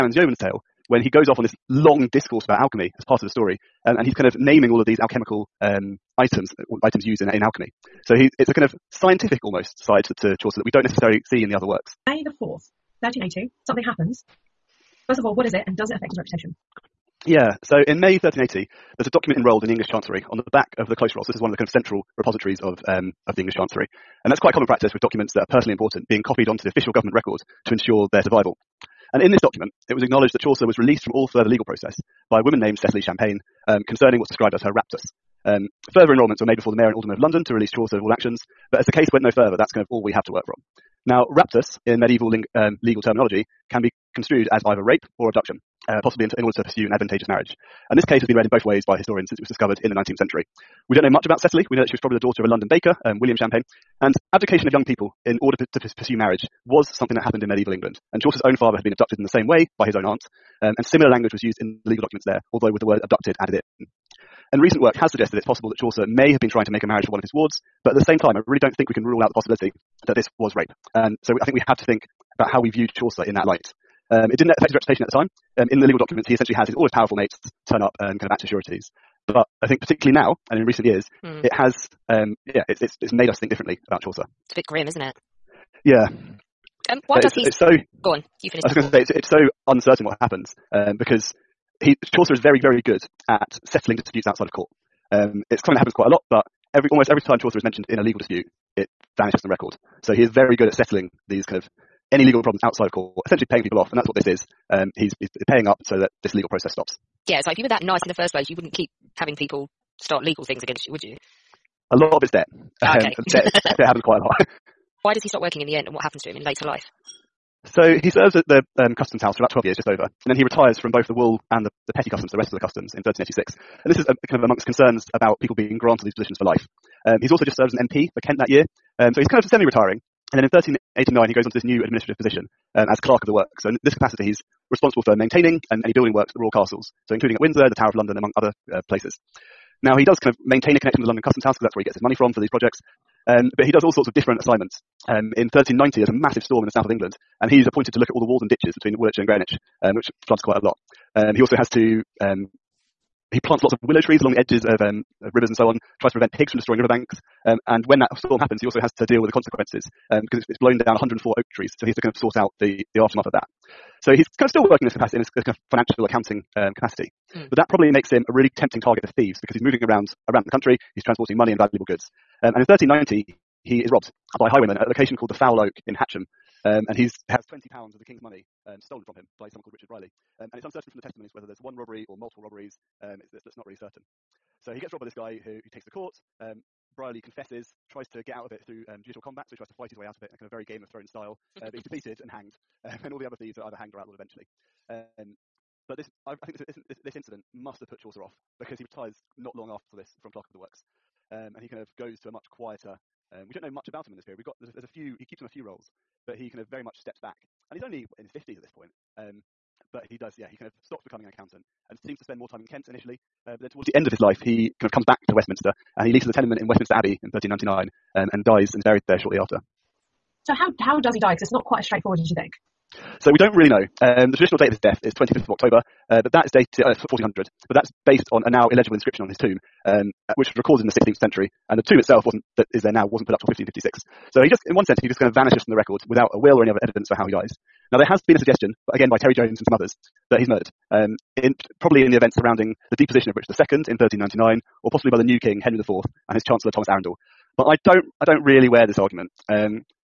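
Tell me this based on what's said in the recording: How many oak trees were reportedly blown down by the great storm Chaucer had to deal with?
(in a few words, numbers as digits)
104.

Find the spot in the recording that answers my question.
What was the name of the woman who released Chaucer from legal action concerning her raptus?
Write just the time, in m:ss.
0:32.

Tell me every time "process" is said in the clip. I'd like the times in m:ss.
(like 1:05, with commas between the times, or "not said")
0:31, 1:46.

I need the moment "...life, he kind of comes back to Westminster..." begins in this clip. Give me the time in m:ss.
3:34.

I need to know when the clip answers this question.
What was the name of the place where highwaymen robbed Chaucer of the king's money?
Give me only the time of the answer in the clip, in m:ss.
2:55.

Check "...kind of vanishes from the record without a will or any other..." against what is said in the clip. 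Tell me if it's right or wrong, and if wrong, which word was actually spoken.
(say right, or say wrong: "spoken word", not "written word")
right.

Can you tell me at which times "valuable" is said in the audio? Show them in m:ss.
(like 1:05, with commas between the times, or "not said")
2:51.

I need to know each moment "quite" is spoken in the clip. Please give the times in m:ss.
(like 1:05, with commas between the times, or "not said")
0:24, 1:35, 1:54, 2:30, 3:41.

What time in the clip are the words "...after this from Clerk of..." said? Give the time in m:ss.
3:19.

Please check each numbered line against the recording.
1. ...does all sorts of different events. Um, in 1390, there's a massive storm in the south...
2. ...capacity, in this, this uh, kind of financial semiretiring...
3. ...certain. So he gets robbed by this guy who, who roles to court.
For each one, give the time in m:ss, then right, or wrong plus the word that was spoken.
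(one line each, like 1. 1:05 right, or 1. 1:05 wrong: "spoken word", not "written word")
1. 2:23 wrong: "assignments", not "events"
2. 2:44 wrong: "accounting", not "semiretiring"
3. 3:03 wrong: "takes", not "roles".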